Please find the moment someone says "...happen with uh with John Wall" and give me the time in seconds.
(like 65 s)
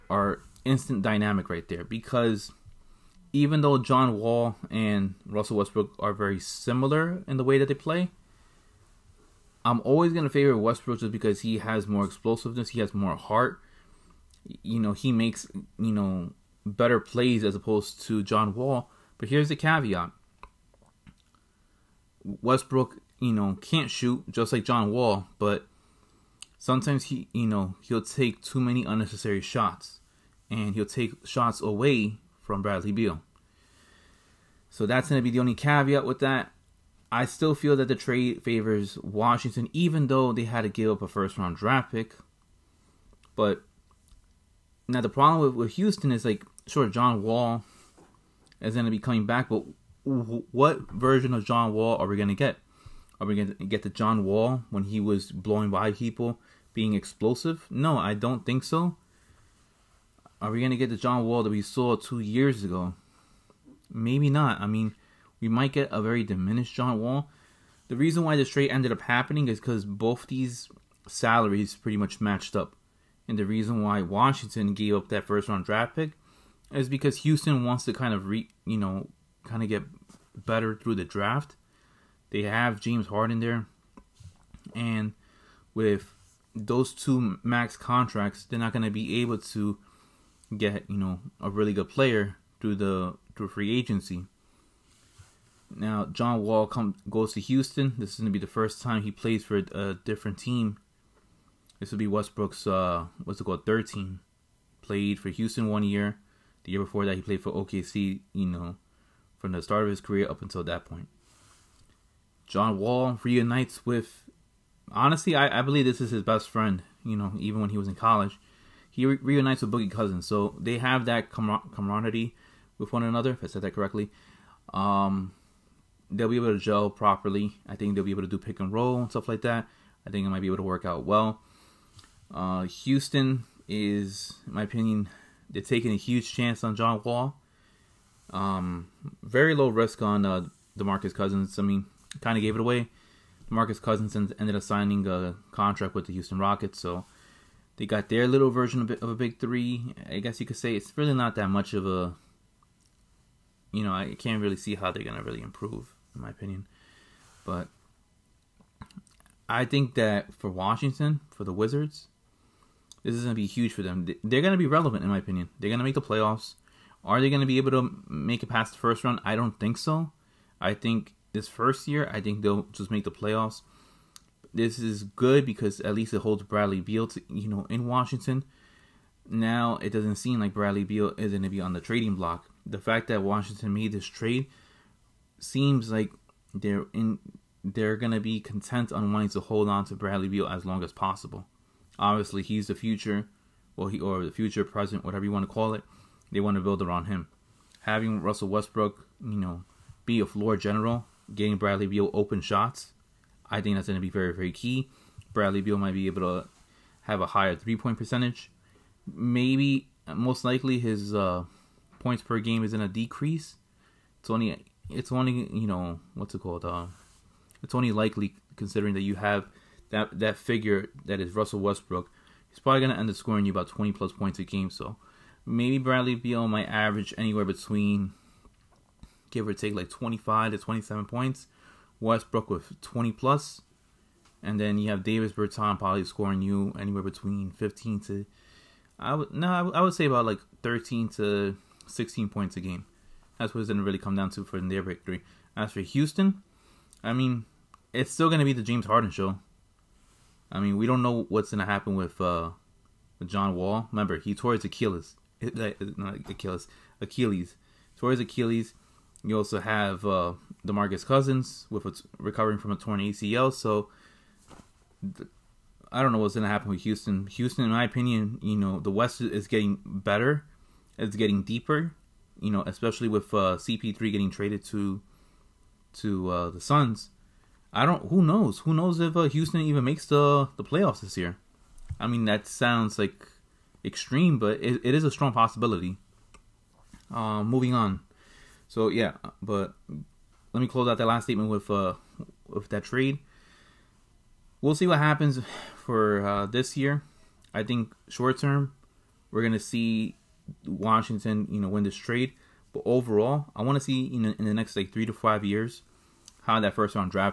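251 s.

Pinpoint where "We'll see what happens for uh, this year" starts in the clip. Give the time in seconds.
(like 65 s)
294 s.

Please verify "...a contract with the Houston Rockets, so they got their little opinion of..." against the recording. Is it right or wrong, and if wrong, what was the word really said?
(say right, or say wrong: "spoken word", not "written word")
wrong: "version", not "opinion".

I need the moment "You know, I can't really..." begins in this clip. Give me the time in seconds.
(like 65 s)
153 s.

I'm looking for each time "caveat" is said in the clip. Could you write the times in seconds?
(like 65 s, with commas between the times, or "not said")
19 s, 35 s.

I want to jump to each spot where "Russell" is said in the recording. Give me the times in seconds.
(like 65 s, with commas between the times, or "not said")
5 s, 198 s, 221 s.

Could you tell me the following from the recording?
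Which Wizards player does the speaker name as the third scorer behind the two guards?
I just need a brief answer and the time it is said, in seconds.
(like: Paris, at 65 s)
Davis Berton, at 235 s.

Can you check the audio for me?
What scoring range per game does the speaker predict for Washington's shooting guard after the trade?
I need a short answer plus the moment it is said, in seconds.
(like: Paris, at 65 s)
25 to 27 points, at 229 s.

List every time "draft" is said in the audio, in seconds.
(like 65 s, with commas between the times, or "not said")
41 s, 75 s, 81 s.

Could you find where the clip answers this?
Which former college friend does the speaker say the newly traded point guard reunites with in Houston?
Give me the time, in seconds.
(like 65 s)
119 s.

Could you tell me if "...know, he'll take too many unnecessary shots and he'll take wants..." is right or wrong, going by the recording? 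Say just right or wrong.
wrong.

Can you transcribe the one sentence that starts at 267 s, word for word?
Houston, in my opinion, you know the West is getting better.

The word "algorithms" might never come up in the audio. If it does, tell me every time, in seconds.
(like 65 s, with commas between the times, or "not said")
not said.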